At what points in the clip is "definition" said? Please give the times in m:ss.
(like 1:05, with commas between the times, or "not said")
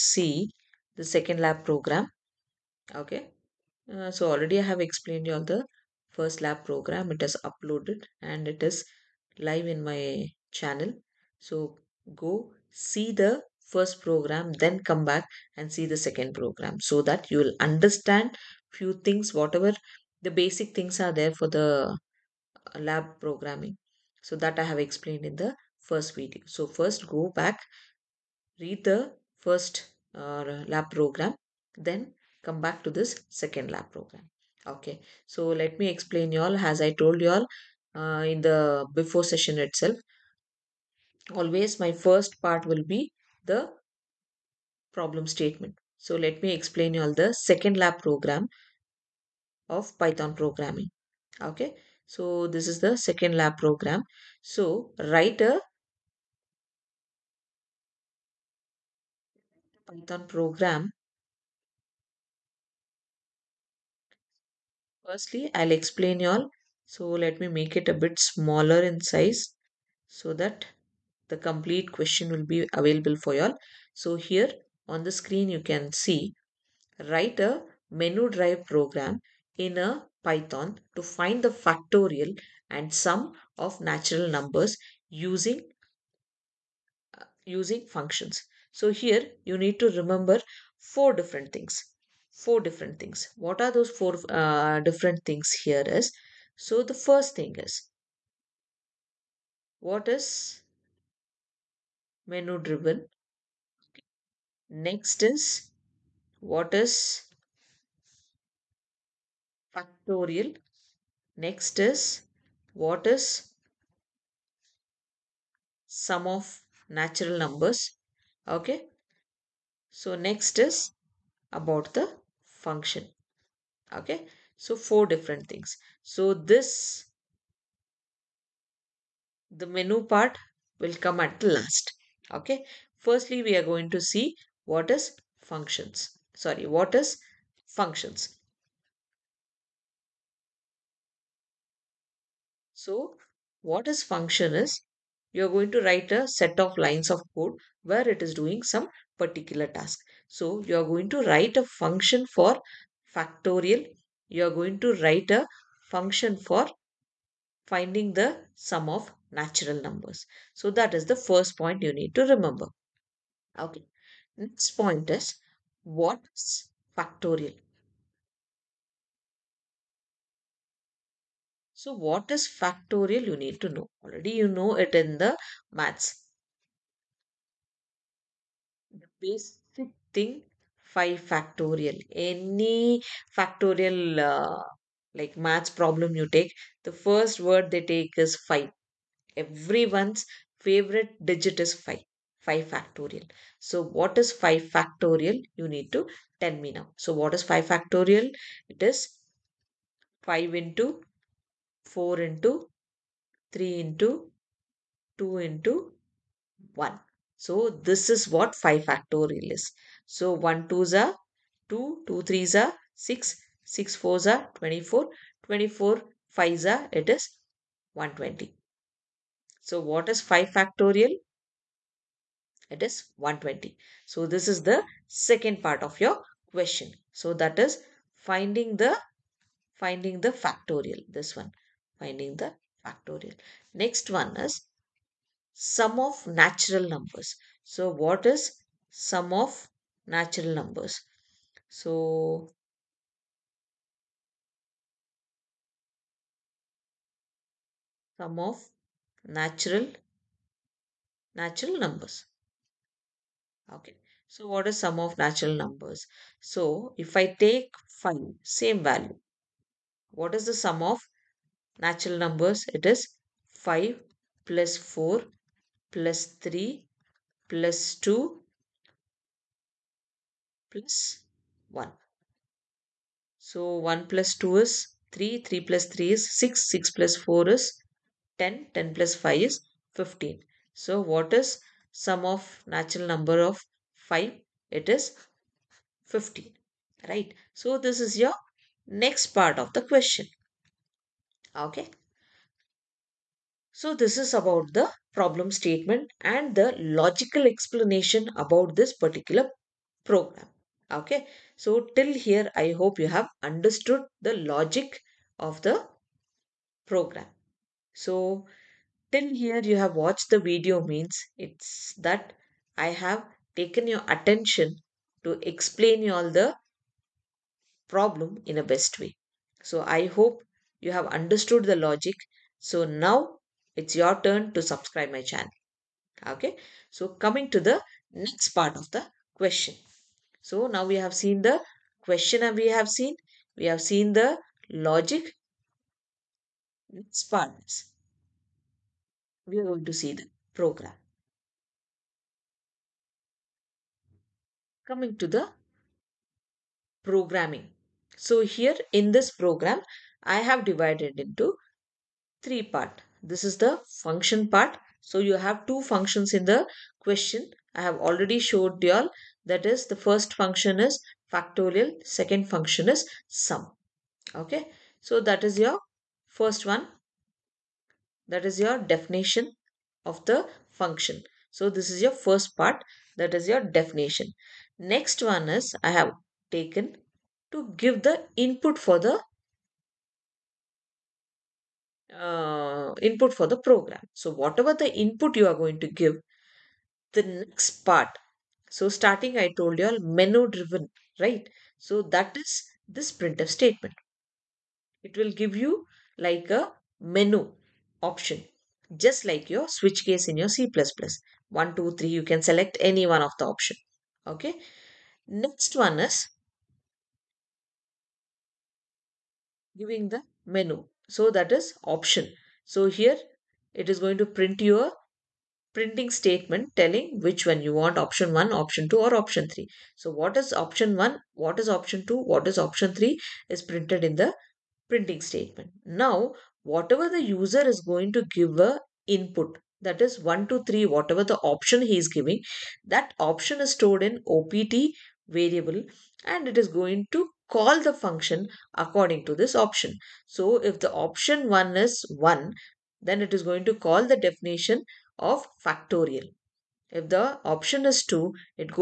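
6:08, 6:13, 7:24.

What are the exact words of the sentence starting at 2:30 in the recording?
So you're going to write a function for factorial.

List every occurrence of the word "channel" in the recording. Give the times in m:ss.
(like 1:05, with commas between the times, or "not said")
0:10, 5:25.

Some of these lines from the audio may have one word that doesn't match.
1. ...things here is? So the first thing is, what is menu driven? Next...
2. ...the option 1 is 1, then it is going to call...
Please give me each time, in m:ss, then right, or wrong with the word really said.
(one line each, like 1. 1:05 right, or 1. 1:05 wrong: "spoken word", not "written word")
1. 1:35 right
2. 7:20 right.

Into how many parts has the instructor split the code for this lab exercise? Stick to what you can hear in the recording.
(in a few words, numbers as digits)
3.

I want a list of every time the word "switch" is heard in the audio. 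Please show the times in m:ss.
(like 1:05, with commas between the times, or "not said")
6:39.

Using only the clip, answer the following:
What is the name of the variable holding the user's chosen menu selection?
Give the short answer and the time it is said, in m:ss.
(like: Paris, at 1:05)
opt, at 7:14.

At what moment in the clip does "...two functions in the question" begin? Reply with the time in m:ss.
5:55.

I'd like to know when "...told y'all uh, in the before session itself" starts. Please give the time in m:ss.
0:36.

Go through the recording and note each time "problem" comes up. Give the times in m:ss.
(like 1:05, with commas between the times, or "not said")
0:44, 3:05, 4:55, 5:17.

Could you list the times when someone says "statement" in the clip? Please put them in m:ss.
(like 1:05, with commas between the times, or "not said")
0:45, 4:55, 6:33, 6:56, 7:05.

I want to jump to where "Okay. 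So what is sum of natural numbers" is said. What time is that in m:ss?
4:13.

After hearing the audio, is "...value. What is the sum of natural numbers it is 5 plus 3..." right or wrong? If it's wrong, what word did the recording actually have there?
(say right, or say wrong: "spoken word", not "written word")
wrong: "4", not "3".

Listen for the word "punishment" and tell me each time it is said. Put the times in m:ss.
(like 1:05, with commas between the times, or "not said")
not said.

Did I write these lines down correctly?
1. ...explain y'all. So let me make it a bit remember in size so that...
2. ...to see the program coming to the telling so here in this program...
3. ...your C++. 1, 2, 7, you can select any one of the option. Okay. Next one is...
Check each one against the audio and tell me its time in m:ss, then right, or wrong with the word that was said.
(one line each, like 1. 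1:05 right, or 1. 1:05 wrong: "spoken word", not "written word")
1. 1:05 wrong: "smaller", not "remember"
2. 5:39 wrong: "programming", not "telling"
3. 6:40 wrong: "3", not "7".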